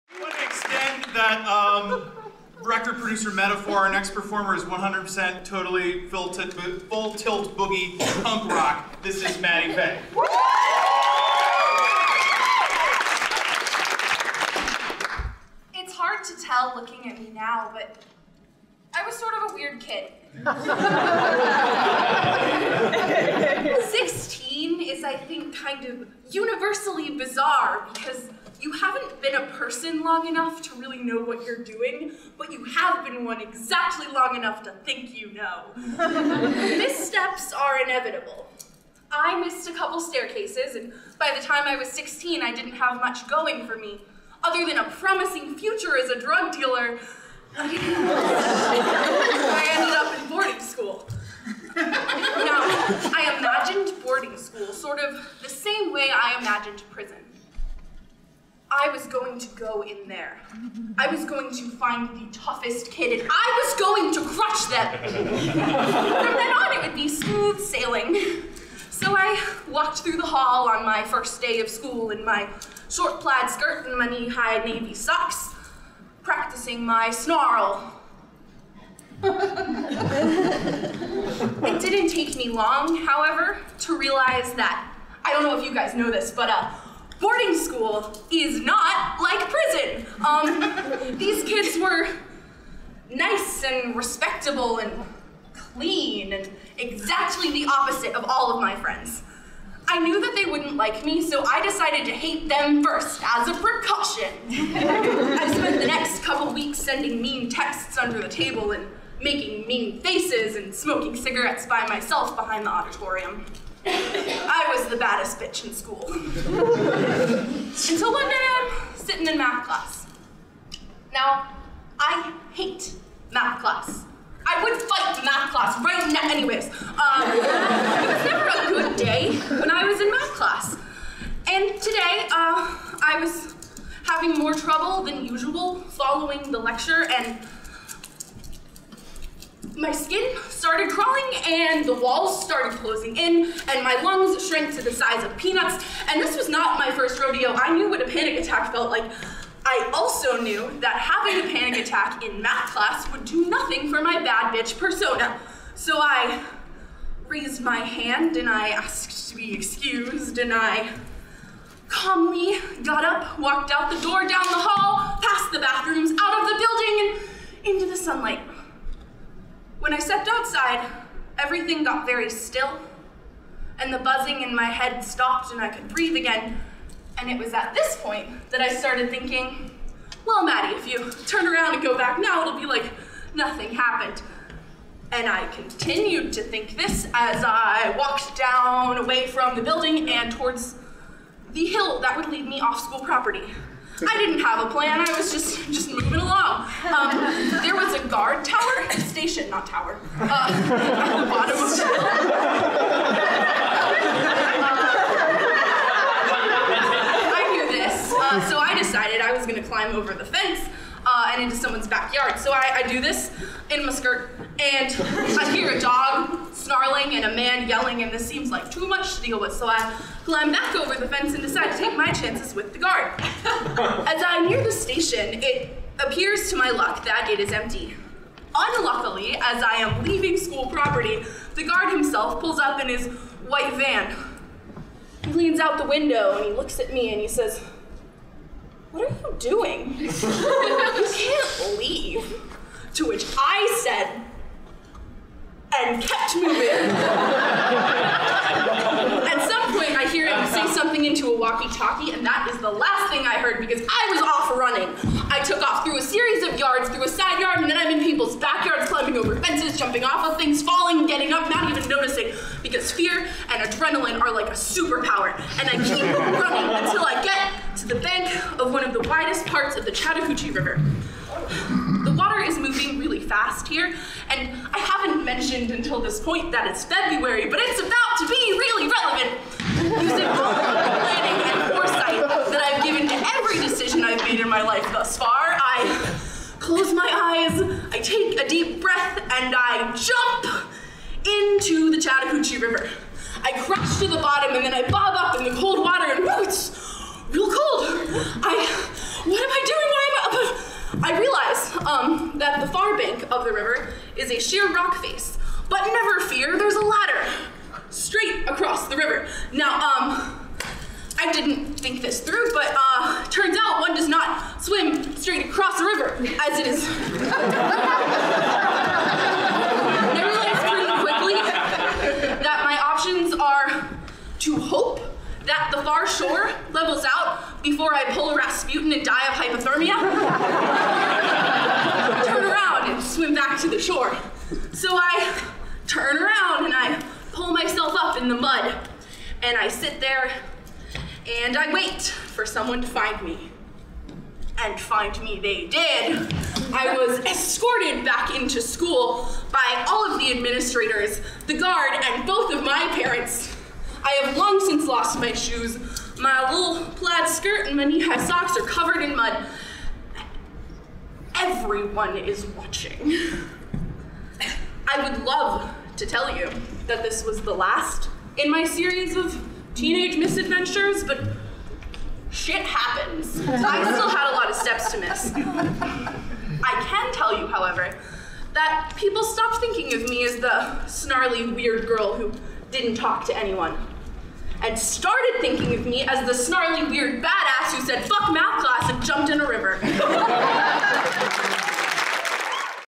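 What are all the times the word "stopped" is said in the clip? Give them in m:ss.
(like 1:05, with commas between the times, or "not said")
2:55, 6:19.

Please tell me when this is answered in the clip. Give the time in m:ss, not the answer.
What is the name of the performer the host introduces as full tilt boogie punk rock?
0:09.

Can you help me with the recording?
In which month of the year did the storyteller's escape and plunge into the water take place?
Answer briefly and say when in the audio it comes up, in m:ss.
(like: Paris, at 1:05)
February, at 4:36.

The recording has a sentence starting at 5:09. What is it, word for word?
Now, um, I didn't think this through, but uh, turns out one does not swim straight across the river as it is.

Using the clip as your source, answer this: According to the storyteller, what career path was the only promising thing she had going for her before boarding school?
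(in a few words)
Drug dealer.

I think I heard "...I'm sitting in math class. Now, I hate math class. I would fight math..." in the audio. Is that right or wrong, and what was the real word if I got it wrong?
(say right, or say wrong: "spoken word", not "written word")
right.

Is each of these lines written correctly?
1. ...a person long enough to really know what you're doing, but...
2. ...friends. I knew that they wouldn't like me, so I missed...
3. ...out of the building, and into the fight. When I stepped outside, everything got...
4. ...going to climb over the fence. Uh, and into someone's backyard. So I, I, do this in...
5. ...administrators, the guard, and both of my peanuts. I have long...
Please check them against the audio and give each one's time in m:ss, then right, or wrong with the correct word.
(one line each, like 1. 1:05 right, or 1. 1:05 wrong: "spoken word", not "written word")
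1. 0:29 right
2. 1:38 wrong: "decided", not "missed"
3. 2:46 wrong: "sunlight", not "fight"
4. 3:29 right
5. 5:50 wrong: "parents", not "peanuts".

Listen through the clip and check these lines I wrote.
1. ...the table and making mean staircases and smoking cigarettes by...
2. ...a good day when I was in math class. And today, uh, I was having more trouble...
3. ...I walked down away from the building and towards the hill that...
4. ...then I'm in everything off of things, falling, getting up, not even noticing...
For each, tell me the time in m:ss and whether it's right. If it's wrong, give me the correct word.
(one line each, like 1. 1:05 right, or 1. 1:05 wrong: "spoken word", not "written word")
1. 1:48 wrong: "faces", not "staircases"
2. 2:08 right
3. 3:07 right
4. 4:17 wrong: "jumping", not "everything".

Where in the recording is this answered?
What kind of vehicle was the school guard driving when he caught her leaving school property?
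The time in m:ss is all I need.
3:53.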